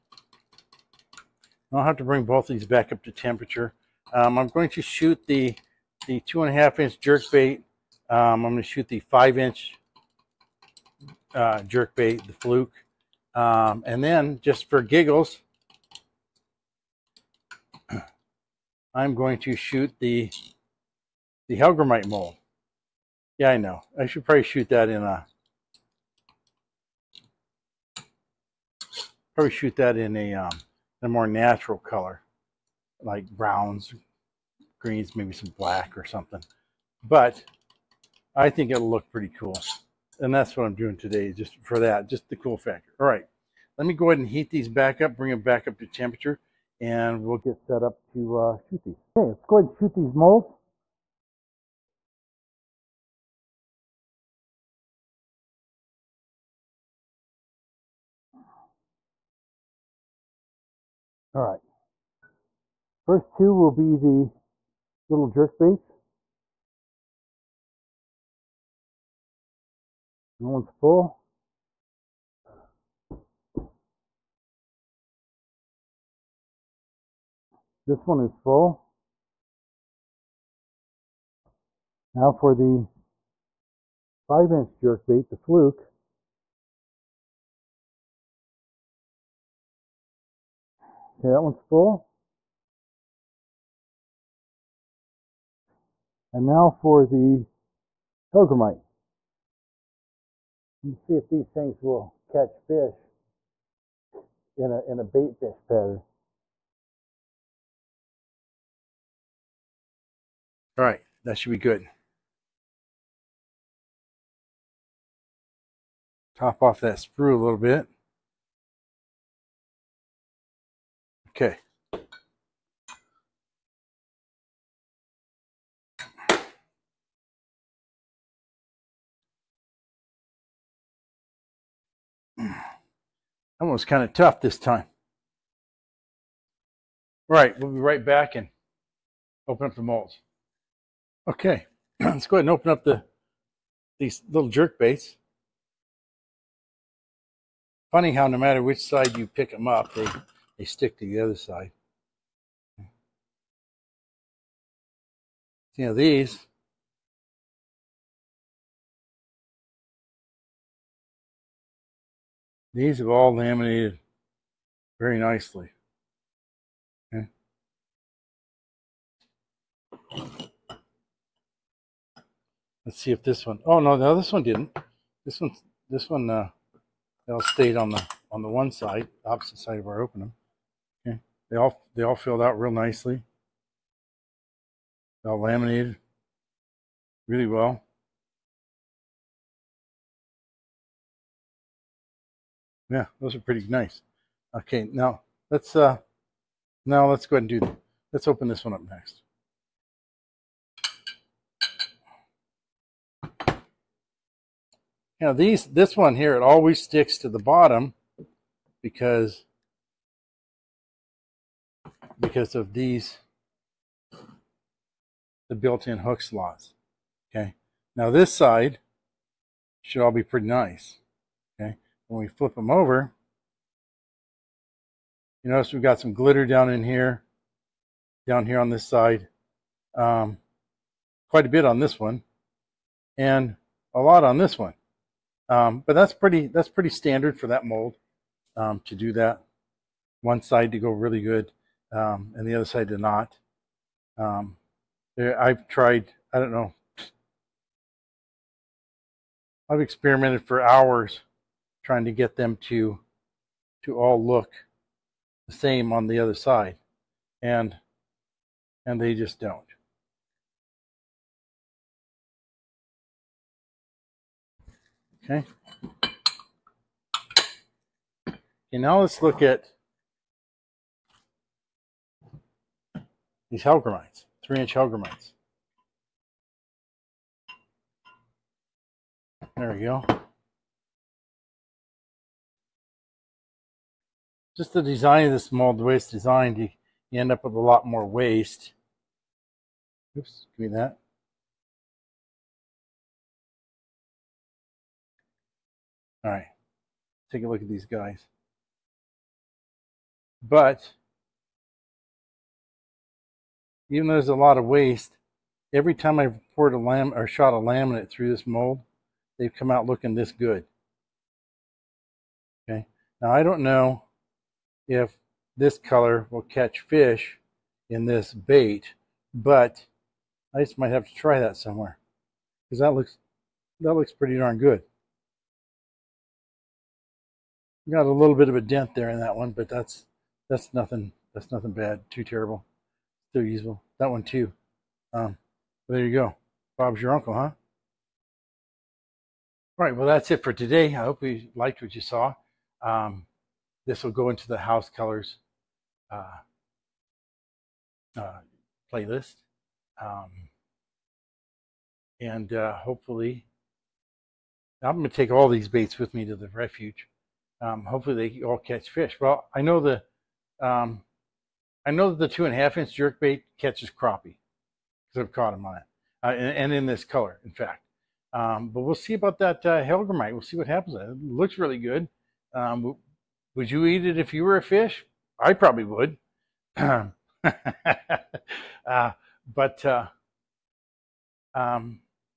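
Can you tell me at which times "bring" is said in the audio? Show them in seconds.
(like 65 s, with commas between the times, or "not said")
2 s, 45 s.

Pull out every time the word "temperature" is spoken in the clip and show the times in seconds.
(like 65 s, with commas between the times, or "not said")
3 s, 45 s.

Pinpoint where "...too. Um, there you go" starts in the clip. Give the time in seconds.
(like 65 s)
334 s.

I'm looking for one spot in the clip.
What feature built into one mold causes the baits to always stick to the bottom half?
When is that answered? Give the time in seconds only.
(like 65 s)
215 s.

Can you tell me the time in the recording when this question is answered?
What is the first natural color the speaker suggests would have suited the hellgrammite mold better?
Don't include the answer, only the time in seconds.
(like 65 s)
33 s.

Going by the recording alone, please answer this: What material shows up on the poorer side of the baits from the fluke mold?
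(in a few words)
glitter.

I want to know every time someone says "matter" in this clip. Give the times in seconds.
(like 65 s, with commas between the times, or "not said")
148 s.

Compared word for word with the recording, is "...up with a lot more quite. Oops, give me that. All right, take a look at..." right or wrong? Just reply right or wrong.
wrong.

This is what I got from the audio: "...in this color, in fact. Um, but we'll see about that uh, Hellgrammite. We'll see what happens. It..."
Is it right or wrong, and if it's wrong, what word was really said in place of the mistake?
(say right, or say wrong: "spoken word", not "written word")
right.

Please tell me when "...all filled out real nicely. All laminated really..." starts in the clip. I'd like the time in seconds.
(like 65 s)
182 s.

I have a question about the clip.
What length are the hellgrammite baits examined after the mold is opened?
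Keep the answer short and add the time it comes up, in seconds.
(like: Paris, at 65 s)
3 inch, at 274 s.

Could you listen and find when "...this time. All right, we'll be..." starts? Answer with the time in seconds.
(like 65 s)
134 s.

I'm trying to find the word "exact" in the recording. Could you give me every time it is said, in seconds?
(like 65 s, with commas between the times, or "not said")
not said.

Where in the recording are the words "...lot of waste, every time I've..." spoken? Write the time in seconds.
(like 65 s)
304 s.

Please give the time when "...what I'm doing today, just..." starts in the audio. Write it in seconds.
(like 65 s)
40 s.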